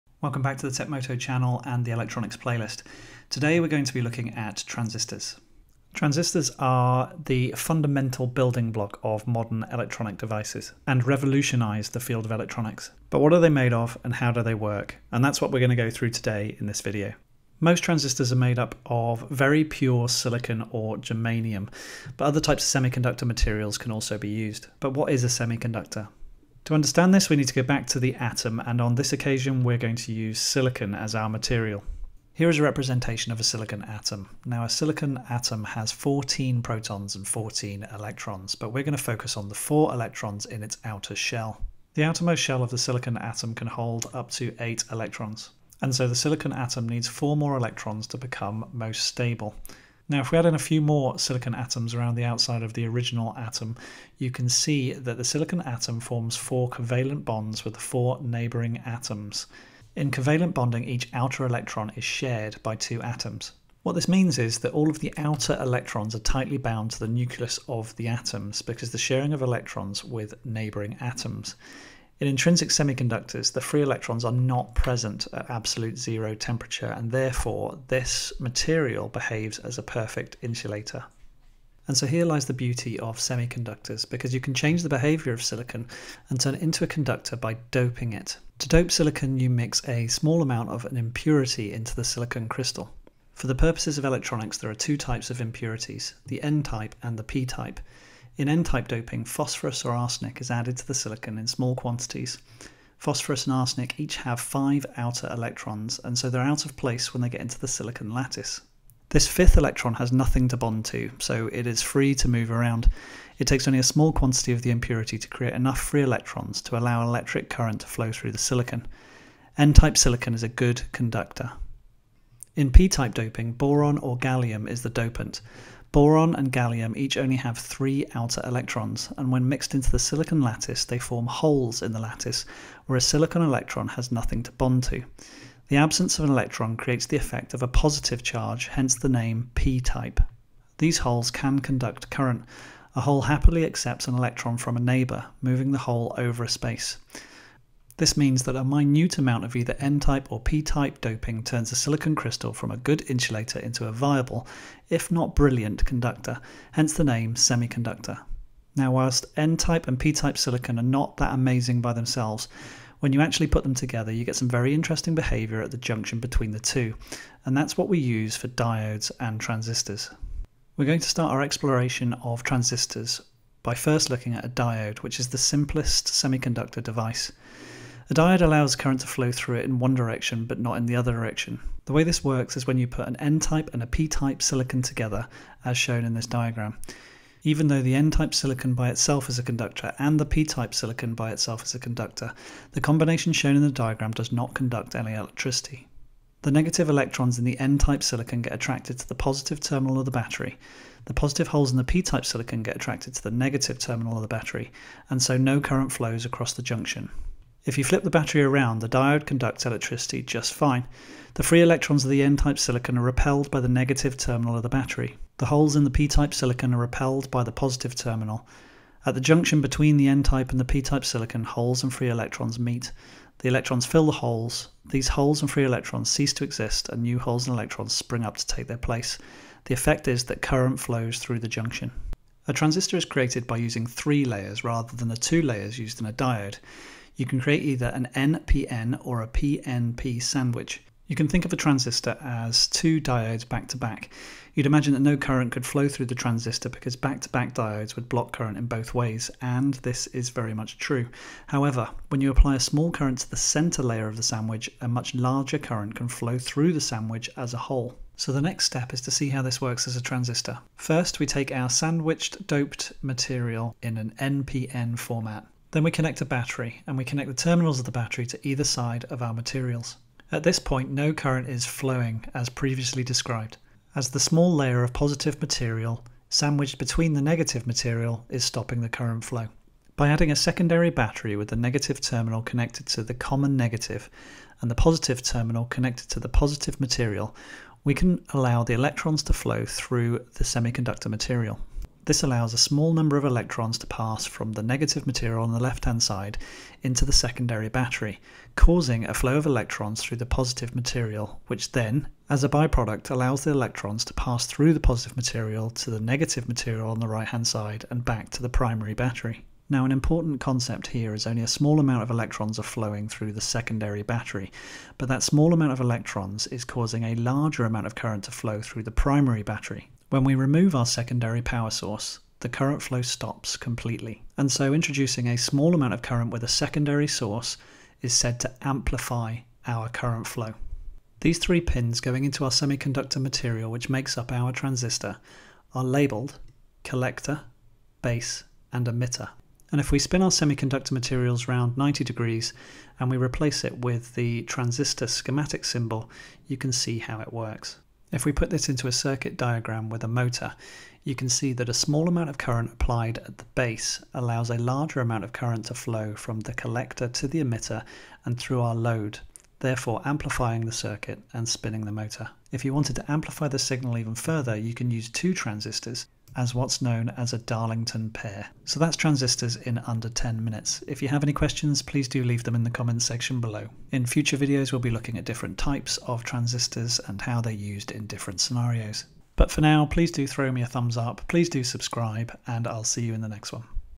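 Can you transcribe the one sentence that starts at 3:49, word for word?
The effect is that current flows through the junction.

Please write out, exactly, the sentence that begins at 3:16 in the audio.
The negative electrons in the N-type silicon get attracted to the positive terminal of the battery.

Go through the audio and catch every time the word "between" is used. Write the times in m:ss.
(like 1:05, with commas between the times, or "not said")
2:46, 3:39, 4:36.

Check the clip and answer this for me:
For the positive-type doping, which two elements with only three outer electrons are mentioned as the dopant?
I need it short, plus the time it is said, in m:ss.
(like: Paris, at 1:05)
Boron or gallium, at 2:03.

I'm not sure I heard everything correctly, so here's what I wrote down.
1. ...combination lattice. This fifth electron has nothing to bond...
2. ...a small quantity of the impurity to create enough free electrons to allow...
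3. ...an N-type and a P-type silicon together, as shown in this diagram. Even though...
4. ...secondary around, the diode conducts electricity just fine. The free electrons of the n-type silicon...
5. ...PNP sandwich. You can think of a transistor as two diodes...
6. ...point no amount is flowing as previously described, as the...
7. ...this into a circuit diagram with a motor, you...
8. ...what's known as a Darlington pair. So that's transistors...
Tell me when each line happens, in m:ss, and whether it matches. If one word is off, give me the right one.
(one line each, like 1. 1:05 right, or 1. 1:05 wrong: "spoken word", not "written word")
1. 1:47 wrong: "silicon", not "combination"
2. 1:53 right
3. 3:03 right
4. 3:28 wrong: "battery", not "secondary"
5. 3:59 right
6. 4:30 wrong: "current", not "amount"
7. 5:48 right
8. 6:06 right.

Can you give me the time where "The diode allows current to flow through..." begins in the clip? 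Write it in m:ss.
2:58.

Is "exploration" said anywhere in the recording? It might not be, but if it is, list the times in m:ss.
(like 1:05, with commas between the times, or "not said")
2:51.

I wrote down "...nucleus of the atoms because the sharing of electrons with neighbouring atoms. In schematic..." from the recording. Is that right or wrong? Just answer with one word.
wrong.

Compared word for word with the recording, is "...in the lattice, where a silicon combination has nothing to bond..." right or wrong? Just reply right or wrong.
wrong.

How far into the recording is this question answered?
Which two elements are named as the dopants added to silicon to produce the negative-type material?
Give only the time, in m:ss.
1:39.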